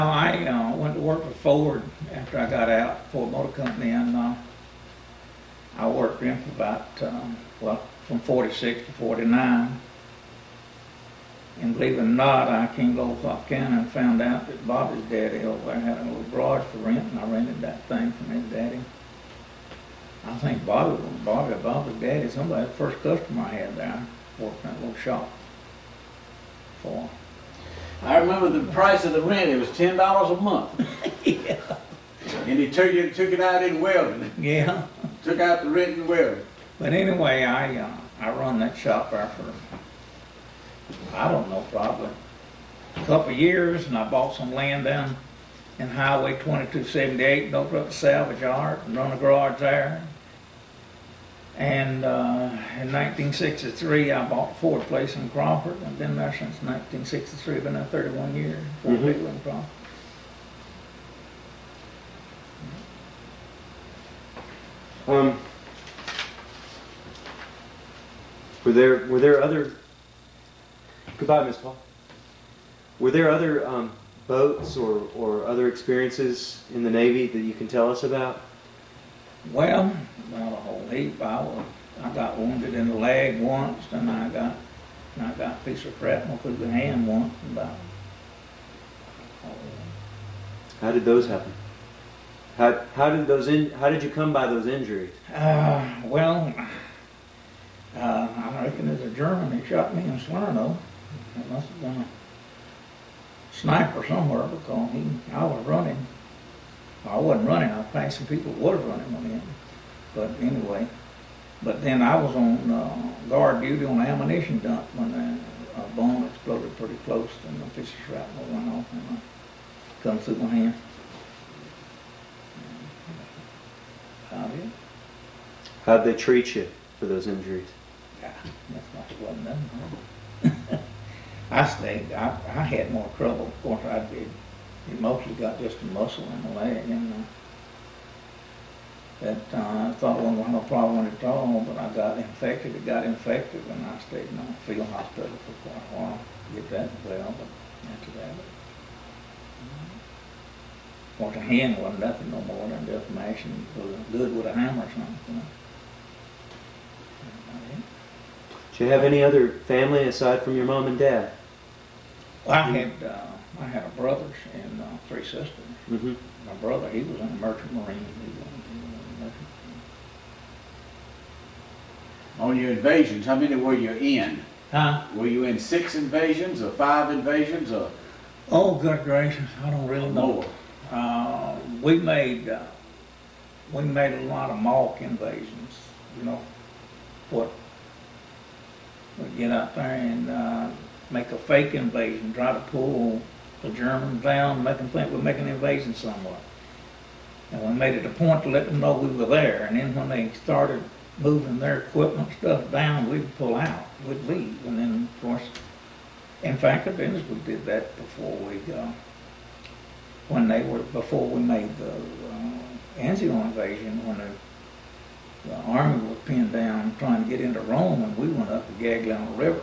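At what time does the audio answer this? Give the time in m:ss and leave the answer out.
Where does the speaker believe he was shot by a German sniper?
1:40.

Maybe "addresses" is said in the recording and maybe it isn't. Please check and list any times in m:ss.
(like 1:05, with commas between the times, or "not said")
not said.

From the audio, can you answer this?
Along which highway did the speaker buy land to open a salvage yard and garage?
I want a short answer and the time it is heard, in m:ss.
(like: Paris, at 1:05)
Highway 2278, at 0:45.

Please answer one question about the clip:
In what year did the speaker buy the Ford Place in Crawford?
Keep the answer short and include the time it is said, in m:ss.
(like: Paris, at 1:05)
1963, at 0:52.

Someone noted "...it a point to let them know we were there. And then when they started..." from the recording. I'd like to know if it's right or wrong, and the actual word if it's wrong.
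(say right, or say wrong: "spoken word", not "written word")
right.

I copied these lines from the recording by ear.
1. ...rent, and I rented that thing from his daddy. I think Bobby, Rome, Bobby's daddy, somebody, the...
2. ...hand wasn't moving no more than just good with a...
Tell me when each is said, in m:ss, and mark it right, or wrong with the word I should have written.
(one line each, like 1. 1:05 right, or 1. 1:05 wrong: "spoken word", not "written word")
1. 0:16 wrong: "Bobby", not "Rome"
2. 2:31 wrong: "nothing", not "moving".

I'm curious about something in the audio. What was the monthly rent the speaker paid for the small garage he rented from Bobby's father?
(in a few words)
$10.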